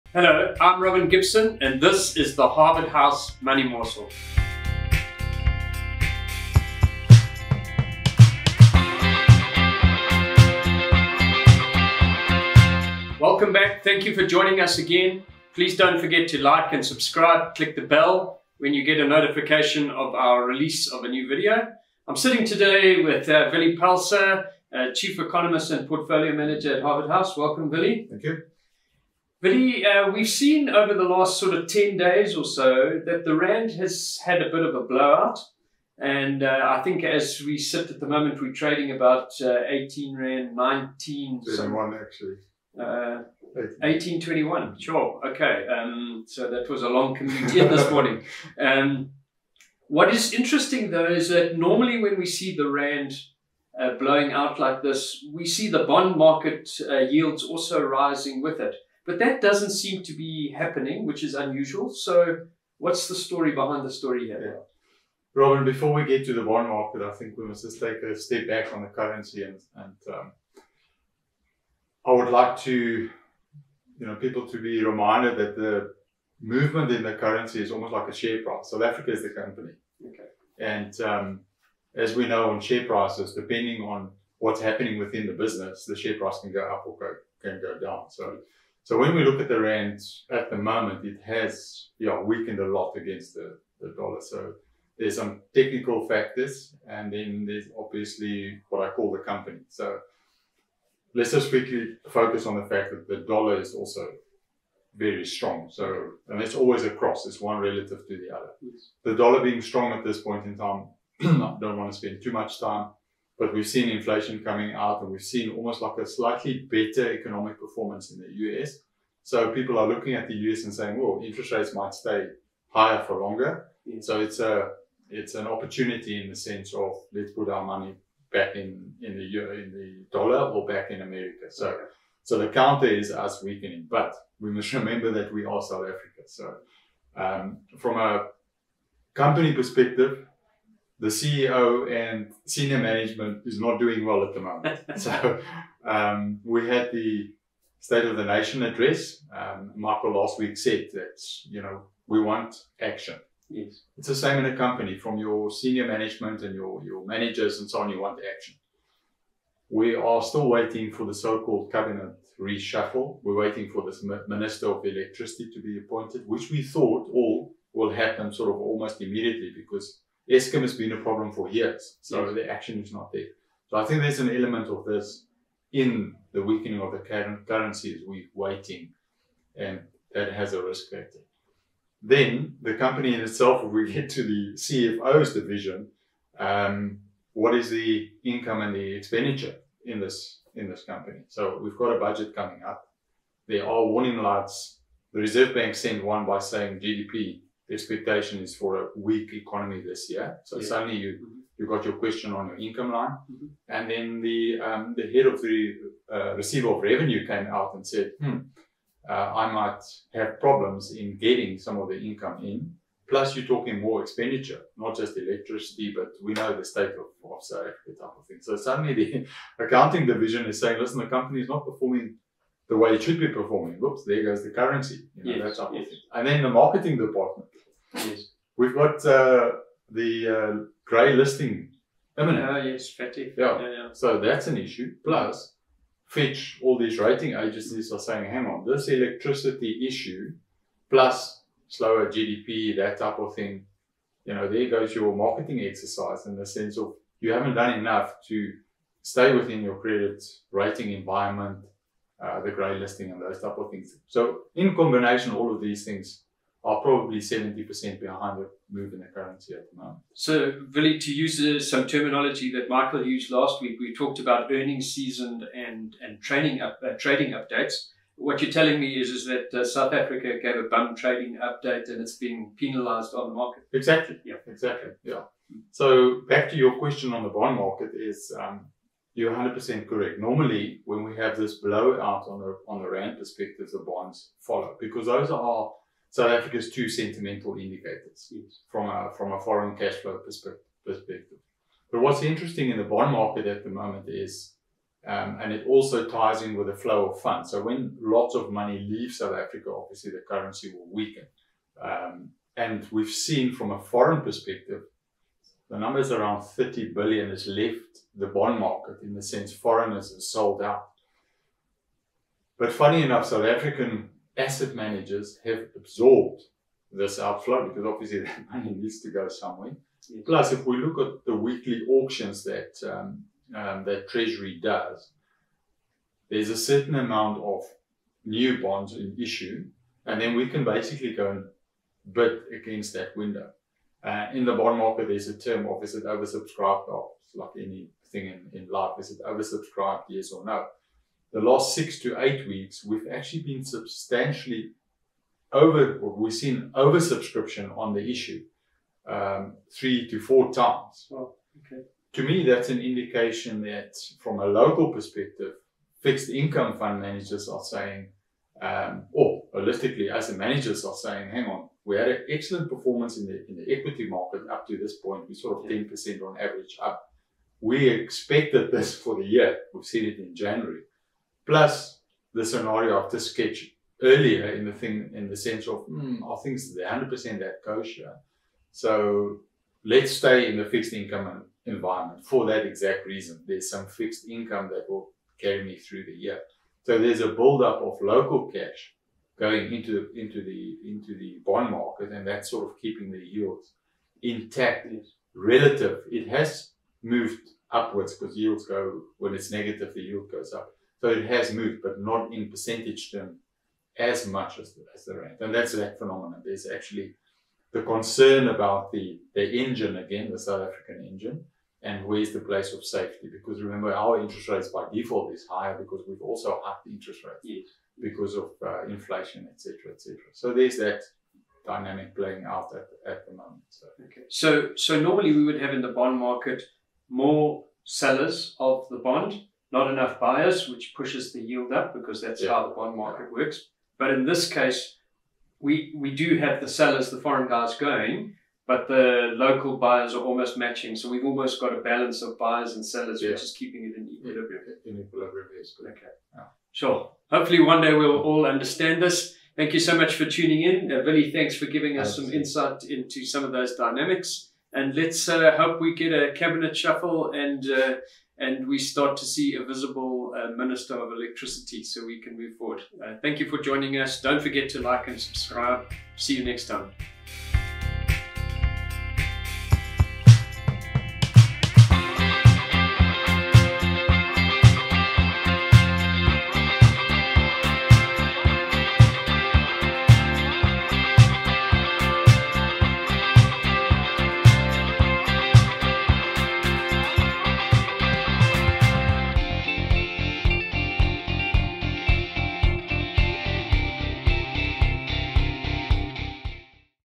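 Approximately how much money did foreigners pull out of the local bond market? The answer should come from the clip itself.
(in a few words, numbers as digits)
30 billion.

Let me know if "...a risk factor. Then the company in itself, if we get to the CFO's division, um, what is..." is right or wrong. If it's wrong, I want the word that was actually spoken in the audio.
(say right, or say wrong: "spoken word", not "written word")
right.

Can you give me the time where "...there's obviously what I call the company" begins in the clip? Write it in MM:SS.
01:37.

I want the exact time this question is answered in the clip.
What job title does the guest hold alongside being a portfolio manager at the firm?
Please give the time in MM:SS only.
00:24.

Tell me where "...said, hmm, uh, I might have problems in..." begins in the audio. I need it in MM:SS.
03:27.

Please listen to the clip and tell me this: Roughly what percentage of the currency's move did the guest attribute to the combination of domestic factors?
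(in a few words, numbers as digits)
70%.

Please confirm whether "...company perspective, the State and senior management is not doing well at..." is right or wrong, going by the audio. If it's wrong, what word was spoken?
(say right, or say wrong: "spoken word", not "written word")
wrong: "CEO", not "State".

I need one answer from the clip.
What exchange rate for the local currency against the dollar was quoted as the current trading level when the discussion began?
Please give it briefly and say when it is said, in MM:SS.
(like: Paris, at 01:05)
18.21, at 00:43.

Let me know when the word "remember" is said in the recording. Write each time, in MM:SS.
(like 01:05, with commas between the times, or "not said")
02:14, 06:53.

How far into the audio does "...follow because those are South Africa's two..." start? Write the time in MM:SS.
04:44.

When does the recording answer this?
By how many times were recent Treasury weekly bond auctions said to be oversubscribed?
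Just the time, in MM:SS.
05:49.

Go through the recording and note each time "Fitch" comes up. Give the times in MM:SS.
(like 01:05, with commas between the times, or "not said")
03:56.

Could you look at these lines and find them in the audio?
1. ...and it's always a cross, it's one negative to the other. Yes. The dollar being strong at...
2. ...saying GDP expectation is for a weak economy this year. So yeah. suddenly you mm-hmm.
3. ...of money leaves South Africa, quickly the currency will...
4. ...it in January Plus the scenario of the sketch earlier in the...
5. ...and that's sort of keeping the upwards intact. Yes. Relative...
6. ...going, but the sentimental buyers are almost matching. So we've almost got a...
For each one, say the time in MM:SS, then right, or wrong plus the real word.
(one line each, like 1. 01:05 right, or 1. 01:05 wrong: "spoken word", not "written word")
1. 01:46 wrong: "relative", not "negative"
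2. 03:16 right
3. 04:58 wrong: "obviously", not "quickly"
4. 06:10 right
5. 06:32 wrong: "yields", not "upwards"
6. 07:17 wrong: "local", not "sentimental".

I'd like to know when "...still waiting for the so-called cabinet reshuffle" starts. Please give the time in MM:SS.
02:40.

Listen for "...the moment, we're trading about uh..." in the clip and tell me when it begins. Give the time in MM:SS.
00:37.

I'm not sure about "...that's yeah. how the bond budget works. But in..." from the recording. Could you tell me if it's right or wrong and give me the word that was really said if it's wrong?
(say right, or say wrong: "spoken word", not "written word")
wrong: "market", not "budget".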